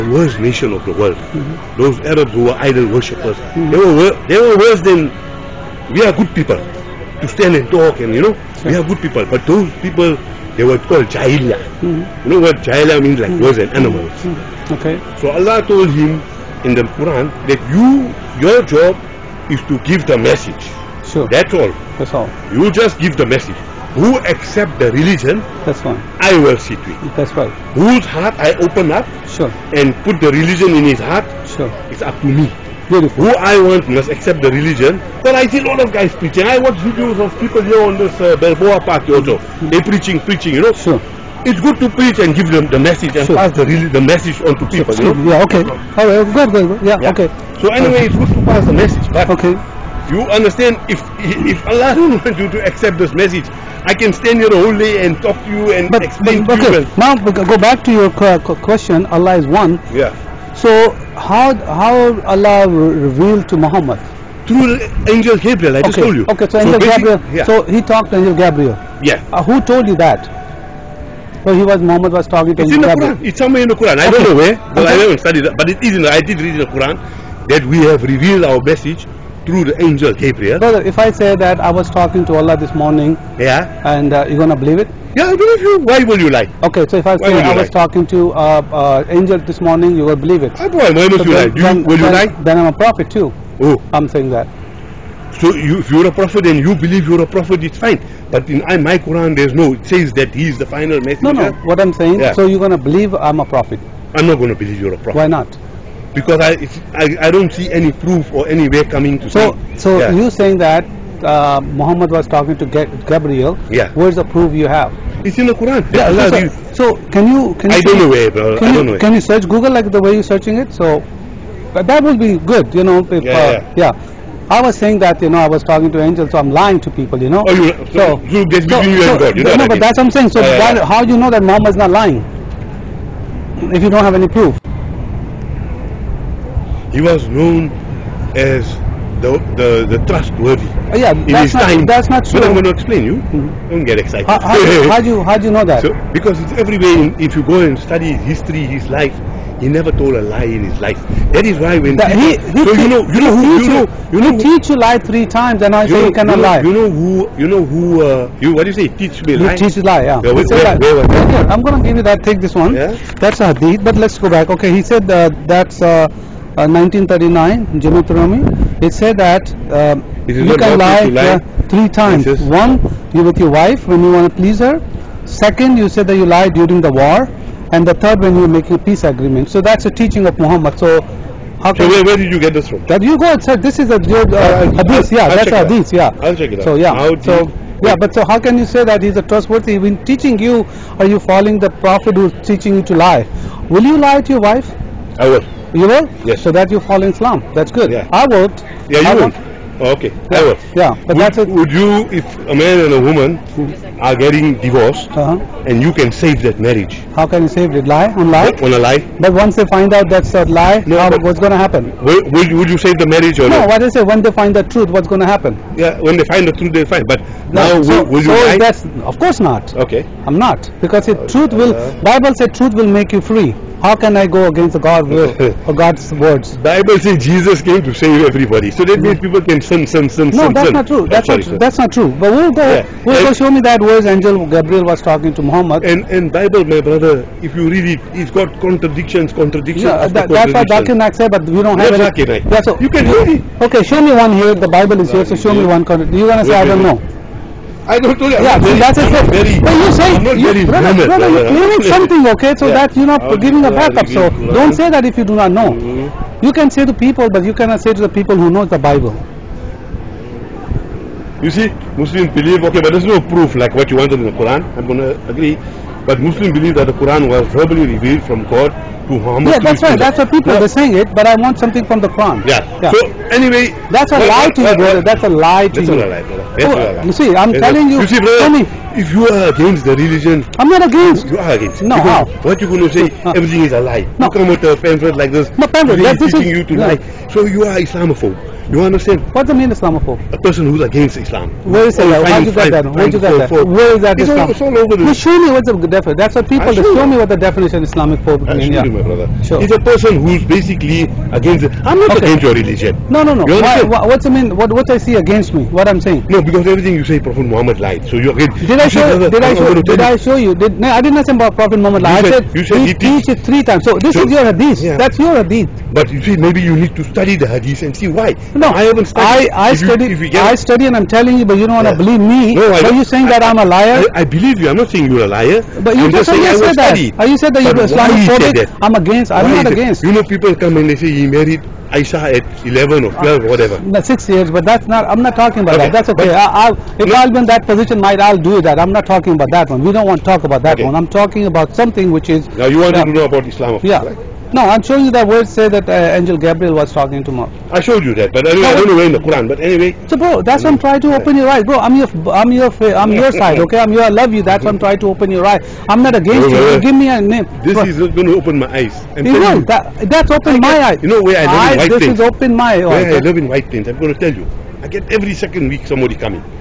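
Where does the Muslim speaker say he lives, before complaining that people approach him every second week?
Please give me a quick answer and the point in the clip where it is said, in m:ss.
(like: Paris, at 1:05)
White Plains, at 6:03.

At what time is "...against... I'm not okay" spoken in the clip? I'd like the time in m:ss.
5:01.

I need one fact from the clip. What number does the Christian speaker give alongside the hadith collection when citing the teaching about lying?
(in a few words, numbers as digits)
1939.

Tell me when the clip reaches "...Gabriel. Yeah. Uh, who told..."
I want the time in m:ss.
1:08.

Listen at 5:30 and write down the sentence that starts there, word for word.
You know, people come and they say he married Aisha at 11 or uh, 12, uh, whatever.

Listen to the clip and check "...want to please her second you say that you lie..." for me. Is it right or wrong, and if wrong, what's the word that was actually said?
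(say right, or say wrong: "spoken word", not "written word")
right.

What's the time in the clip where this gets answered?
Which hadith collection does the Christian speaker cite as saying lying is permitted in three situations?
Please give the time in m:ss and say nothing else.
2:47.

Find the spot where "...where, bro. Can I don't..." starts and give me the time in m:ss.
1:58.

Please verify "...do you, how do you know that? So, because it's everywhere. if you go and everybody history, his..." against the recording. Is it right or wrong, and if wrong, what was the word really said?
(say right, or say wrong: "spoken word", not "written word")
wrong: "study", not "everybody".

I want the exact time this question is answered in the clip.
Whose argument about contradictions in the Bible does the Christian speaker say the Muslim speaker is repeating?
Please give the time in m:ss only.
4:00.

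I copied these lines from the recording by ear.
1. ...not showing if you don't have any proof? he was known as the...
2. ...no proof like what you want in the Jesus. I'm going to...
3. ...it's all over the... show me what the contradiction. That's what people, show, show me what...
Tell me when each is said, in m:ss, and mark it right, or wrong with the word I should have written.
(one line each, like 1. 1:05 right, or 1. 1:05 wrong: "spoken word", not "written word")
1. 2:11 wrong: "lying", not "showing"
2. 4:23 wrong: "Quran", not "Jesus"
3. 4:54 wrong: "definition", not "contradiction".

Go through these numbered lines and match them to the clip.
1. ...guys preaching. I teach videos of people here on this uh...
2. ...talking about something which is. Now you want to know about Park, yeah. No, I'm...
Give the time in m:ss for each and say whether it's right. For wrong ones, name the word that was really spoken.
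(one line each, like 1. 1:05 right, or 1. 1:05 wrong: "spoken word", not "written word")
1. 0:35 wrong: "watch", not "teach"
2. 5:41 wrong: "Islam", not "Park".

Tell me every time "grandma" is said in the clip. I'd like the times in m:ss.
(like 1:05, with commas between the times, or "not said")
not said.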